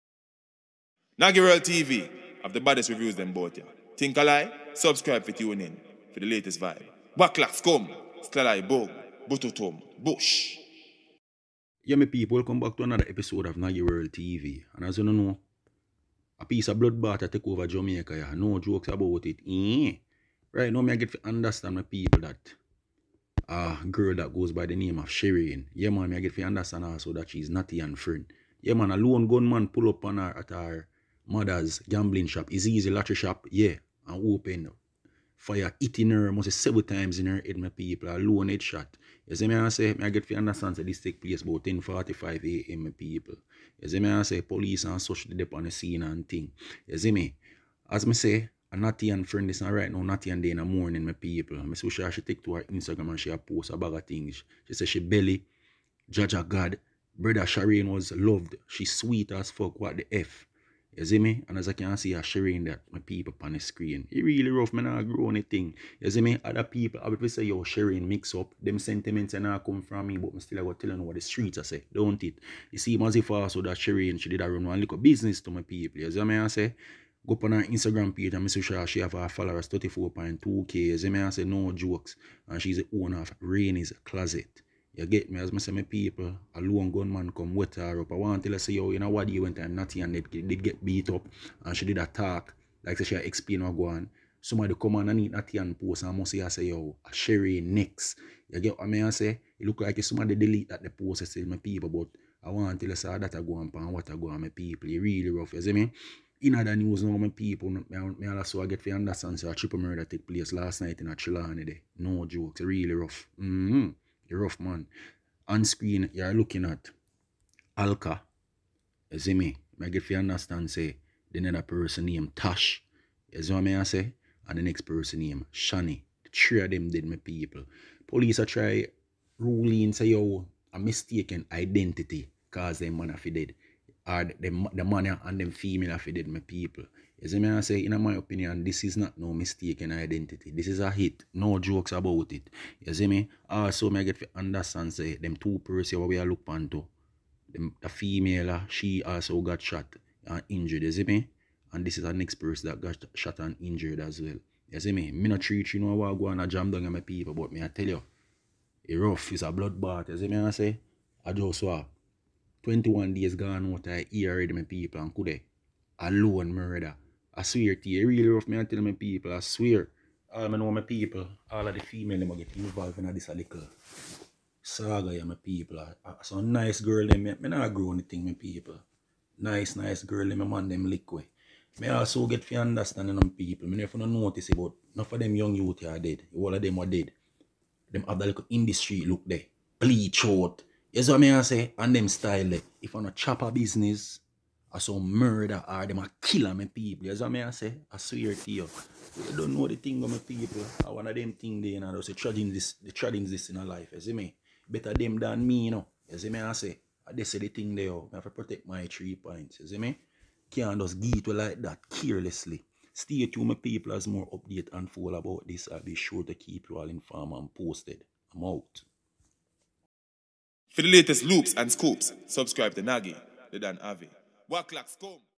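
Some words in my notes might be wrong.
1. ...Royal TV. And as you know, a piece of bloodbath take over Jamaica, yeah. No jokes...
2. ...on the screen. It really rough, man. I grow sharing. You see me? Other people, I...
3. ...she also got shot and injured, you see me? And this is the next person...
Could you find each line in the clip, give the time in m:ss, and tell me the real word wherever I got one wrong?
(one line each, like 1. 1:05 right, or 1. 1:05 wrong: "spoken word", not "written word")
1. 0:13 right
2. 1:03 wrong: "anything", not "sharing"
3. 2:28 right.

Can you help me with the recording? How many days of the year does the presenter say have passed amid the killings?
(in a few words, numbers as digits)
21 days.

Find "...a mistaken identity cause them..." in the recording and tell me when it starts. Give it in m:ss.
2:10.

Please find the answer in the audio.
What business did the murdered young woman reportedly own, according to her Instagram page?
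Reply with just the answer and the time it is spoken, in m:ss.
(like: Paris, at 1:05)
Rainy's Closet, at 1:23.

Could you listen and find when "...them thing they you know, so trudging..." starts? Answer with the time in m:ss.
3:21.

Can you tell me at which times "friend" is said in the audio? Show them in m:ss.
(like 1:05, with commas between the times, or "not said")
0:27, 0:49.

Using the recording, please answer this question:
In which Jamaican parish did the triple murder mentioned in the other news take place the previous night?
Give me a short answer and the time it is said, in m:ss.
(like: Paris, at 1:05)
Trelawny, at 1:51.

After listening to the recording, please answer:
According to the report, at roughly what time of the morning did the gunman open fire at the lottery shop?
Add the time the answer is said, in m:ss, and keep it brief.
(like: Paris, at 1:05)
10:45 a.m., at 0:41.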